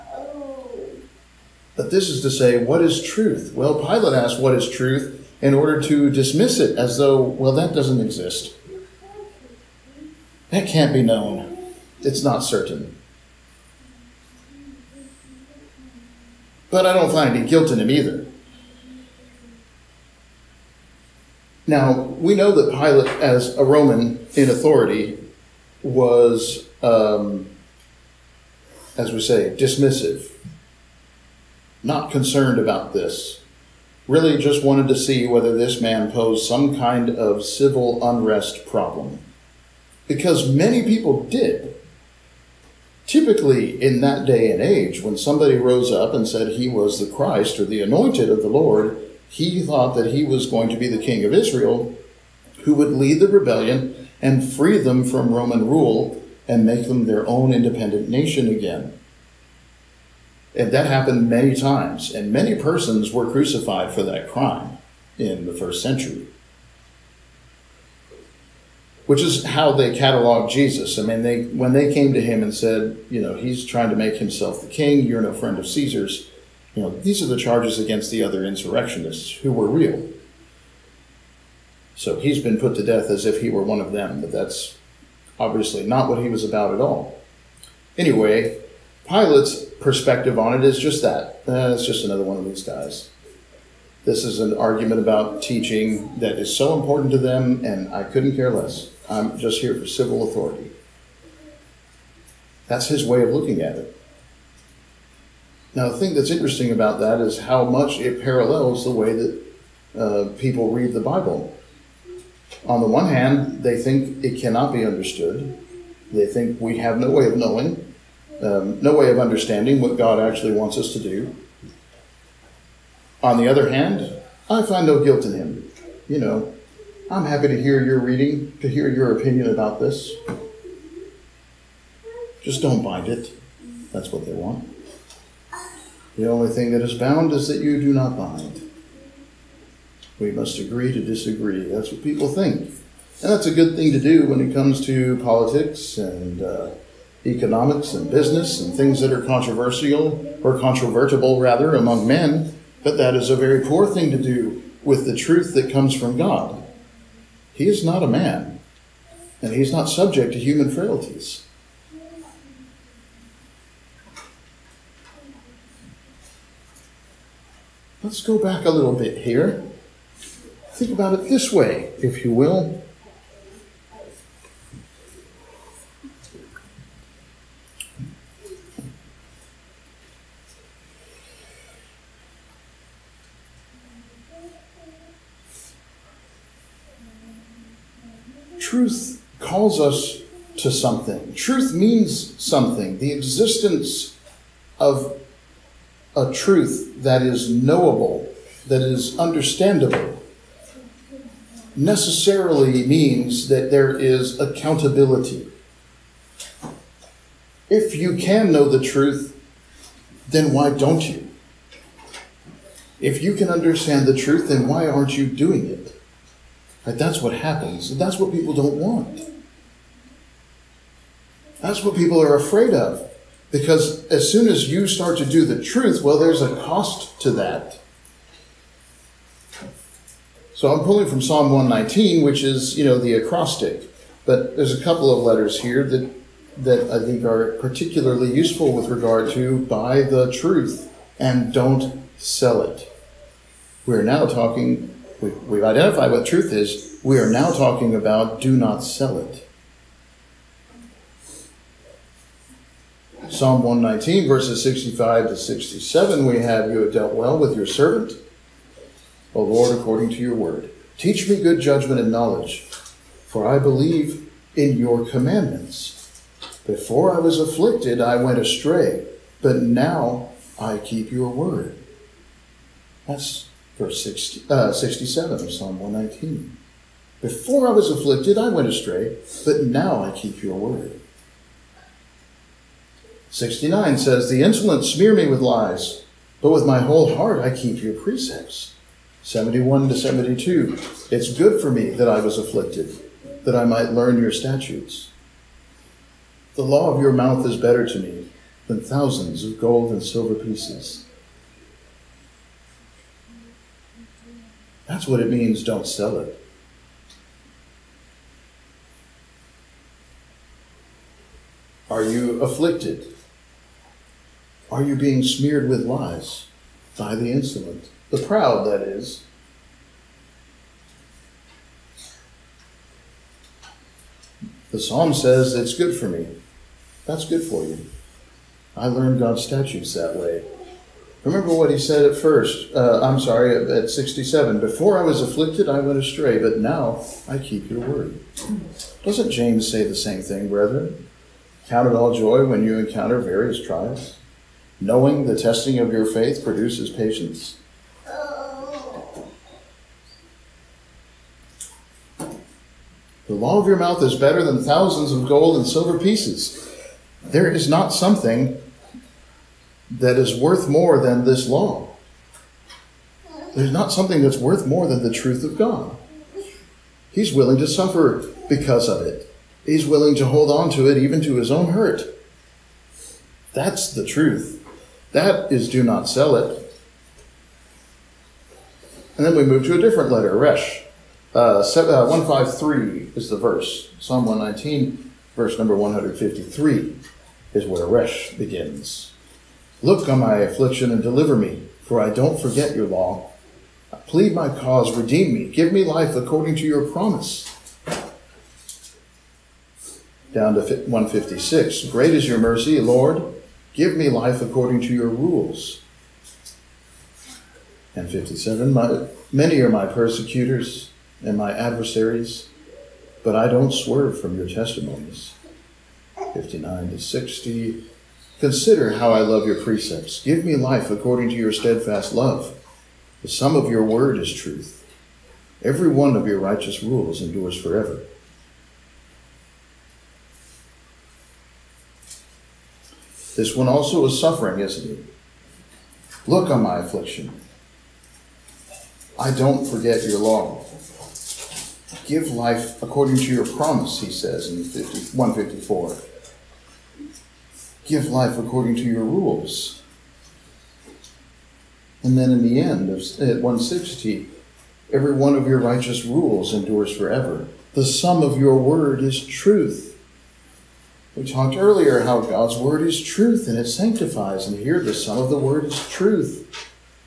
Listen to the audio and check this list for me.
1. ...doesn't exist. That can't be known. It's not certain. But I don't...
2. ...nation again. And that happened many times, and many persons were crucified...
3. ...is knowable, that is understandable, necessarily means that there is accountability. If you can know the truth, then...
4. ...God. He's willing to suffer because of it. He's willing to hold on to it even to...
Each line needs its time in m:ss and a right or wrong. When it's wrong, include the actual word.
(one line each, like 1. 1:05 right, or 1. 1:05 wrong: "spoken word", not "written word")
1. 0:07 right
2. 0:58 right
3. 3:17 right
4. 6:05 right.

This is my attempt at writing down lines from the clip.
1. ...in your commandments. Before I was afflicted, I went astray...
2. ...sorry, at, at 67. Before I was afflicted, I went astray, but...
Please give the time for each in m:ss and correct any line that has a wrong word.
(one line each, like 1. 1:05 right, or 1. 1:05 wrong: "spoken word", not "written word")
1. 4:24 right
2. 5:33 right.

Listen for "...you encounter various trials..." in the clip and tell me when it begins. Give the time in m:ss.
5:42.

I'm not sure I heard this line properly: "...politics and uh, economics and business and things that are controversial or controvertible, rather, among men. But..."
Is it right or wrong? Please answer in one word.
right.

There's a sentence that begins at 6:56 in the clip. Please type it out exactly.
59 to 60, consider how I love your precepts.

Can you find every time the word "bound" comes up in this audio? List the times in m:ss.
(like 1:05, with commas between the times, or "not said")
2:16.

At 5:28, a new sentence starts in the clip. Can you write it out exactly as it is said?
I learned God's statutes that way.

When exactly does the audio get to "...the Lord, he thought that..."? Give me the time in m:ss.
0:48.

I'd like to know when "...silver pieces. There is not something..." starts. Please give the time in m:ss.
5:55.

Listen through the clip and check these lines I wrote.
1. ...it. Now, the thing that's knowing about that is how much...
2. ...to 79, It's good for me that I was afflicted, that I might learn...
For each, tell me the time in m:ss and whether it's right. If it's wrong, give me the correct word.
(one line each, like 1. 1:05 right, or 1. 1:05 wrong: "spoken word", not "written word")
1. 1:43 wrong: "interesting", not "knowing"
2. 4:49 wrong: "72", not "79".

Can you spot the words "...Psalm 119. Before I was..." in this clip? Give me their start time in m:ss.
4:35.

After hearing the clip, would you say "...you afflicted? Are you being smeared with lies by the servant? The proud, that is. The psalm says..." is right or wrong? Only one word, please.
wrong.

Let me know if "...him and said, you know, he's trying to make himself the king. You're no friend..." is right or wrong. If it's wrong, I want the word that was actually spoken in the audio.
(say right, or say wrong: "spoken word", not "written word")
right.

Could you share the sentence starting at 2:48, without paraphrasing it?
Let's go back a little bit here.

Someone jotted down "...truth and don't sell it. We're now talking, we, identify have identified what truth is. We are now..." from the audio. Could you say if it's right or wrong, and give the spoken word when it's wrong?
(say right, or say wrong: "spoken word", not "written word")
right.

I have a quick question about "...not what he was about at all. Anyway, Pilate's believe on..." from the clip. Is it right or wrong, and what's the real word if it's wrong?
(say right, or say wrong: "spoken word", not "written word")
wrong: "perspective", not "believe".